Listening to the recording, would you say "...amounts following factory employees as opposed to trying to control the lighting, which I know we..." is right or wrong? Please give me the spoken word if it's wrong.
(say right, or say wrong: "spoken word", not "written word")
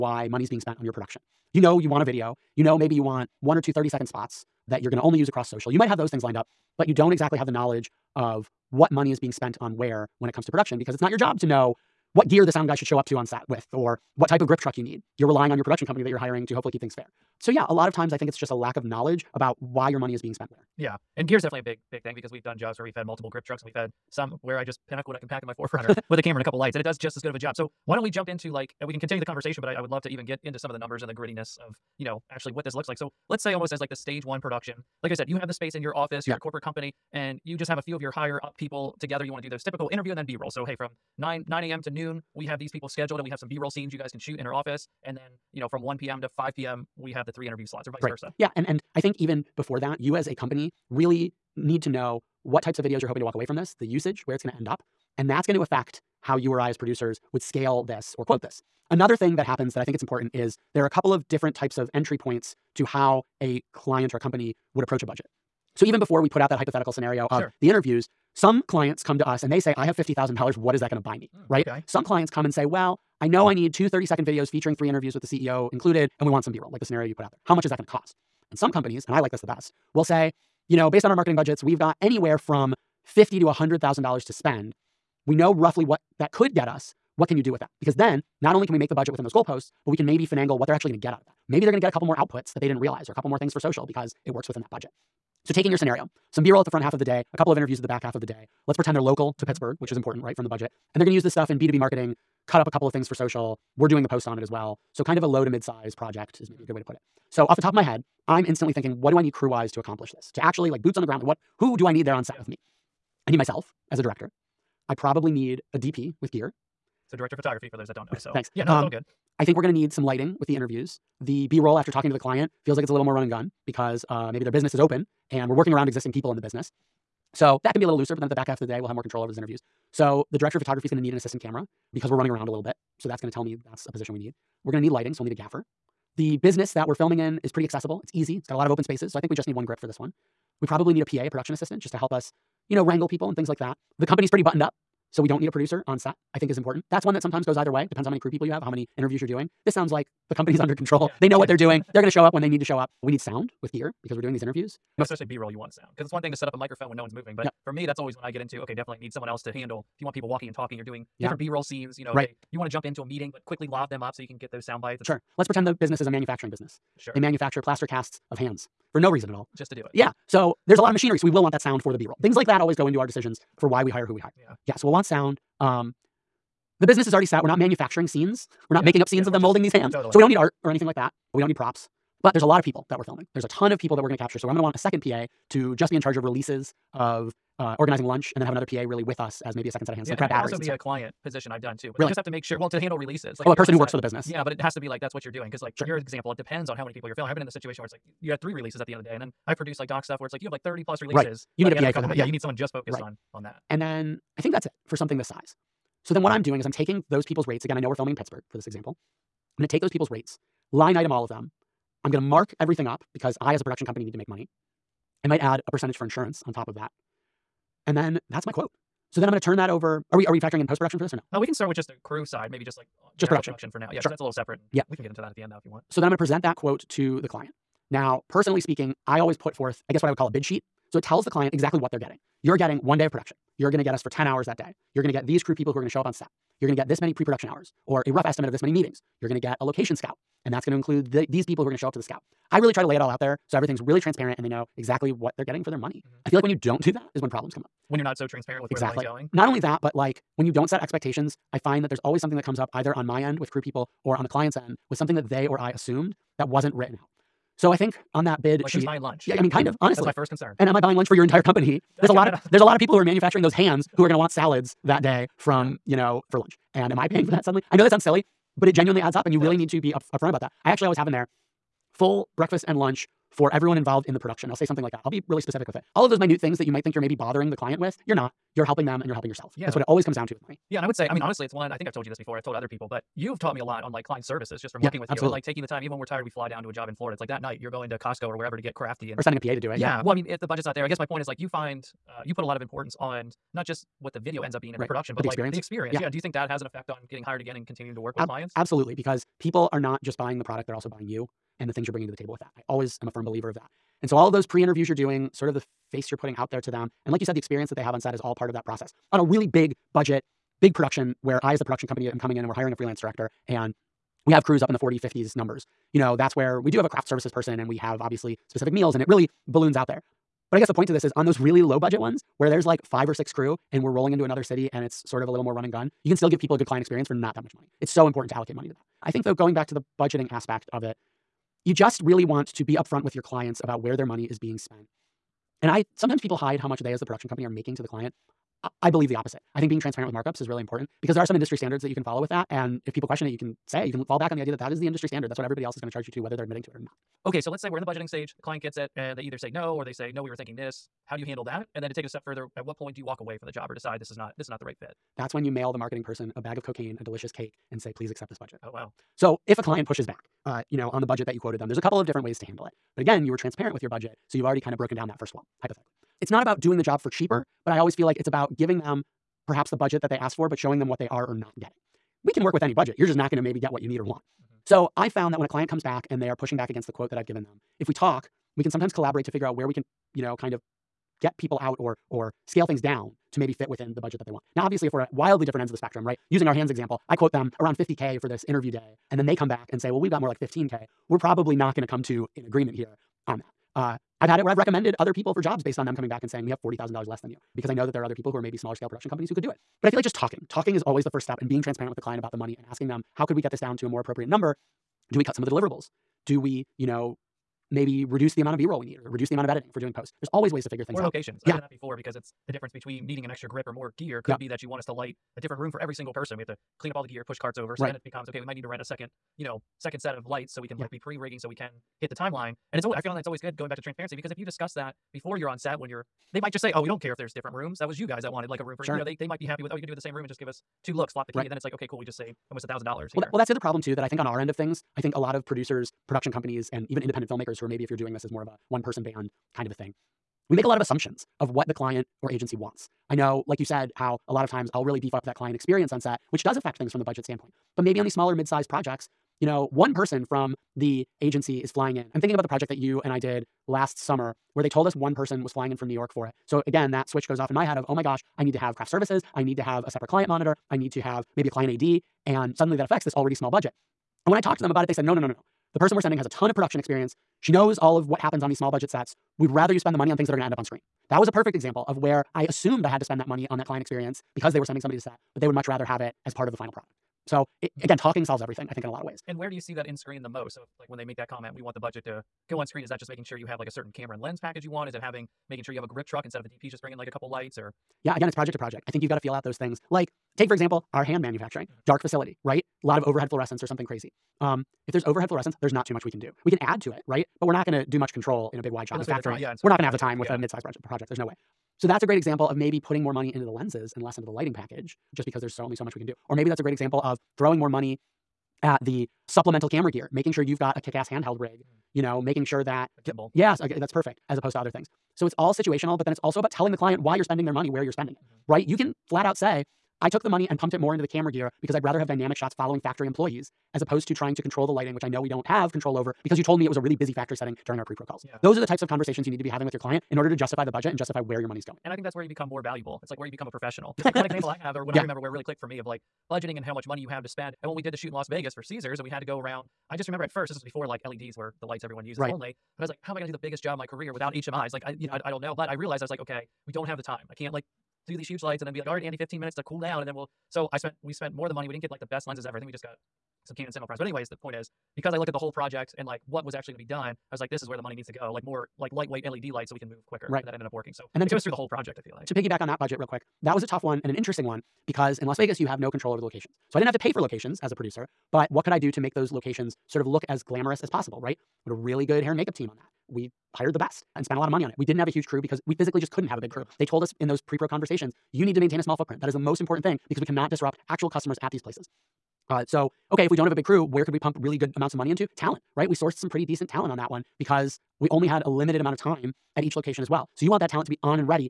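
wrong: "shots", not "amounts".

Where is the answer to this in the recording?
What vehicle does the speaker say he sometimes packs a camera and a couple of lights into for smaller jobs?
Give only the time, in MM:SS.
00:25.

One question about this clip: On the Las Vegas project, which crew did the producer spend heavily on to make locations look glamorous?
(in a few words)
Hair and makeup.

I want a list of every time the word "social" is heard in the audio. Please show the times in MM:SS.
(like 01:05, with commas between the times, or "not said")
00:05, 01:33, 01:43.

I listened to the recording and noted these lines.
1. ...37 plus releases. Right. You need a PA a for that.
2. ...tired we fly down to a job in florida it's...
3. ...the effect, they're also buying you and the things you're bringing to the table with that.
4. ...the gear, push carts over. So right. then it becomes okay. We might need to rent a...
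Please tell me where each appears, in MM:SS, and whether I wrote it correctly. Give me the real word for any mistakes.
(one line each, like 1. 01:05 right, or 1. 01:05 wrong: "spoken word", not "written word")
1. 03:20 wrong: "30", not "37"
2. 04:46 right
3. 05:00 wrong: "product", not "effect"
4. 06:57 right.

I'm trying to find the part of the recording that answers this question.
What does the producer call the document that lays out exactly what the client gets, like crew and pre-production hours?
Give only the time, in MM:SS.
03:50.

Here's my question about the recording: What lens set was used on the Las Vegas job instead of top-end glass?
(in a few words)
Canon Cinema Primes.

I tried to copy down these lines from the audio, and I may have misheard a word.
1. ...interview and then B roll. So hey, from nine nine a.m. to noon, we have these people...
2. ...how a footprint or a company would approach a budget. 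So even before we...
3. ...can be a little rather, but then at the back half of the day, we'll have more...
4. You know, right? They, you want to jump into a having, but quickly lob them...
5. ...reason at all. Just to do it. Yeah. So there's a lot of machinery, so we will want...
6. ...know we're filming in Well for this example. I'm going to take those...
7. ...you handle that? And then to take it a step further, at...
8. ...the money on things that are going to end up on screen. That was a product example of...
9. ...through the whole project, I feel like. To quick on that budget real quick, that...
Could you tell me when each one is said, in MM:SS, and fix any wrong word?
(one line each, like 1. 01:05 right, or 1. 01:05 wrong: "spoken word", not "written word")
1. 00:39 right
2. 01:02 wrong: "client", not "footprint"
3. 02:07 wrong: "looser", not "rather"
4. 02:41 wrong: "meeting", not "having"
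5. 02:49 right
6. 03:27 wrong: "Pittsburgh", not "Well"
7. 05:51 right
8. 07:49 wrong: "perfect", not "product"
9. 09:21 wrong: "piggyback", not "quick".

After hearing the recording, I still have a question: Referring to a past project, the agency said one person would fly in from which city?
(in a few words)
New York.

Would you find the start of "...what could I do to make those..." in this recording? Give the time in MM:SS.
09:28.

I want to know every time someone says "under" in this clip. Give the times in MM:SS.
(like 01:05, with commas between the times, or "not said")
02:30.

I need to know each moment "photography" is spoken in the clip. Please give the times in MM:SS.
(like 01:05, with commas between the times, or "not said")
01:57, 02:10.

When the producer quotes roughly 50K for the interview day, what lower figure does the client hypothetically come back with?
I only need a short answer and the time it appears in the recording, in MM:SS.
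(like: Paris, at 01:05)
15K, at 06:30.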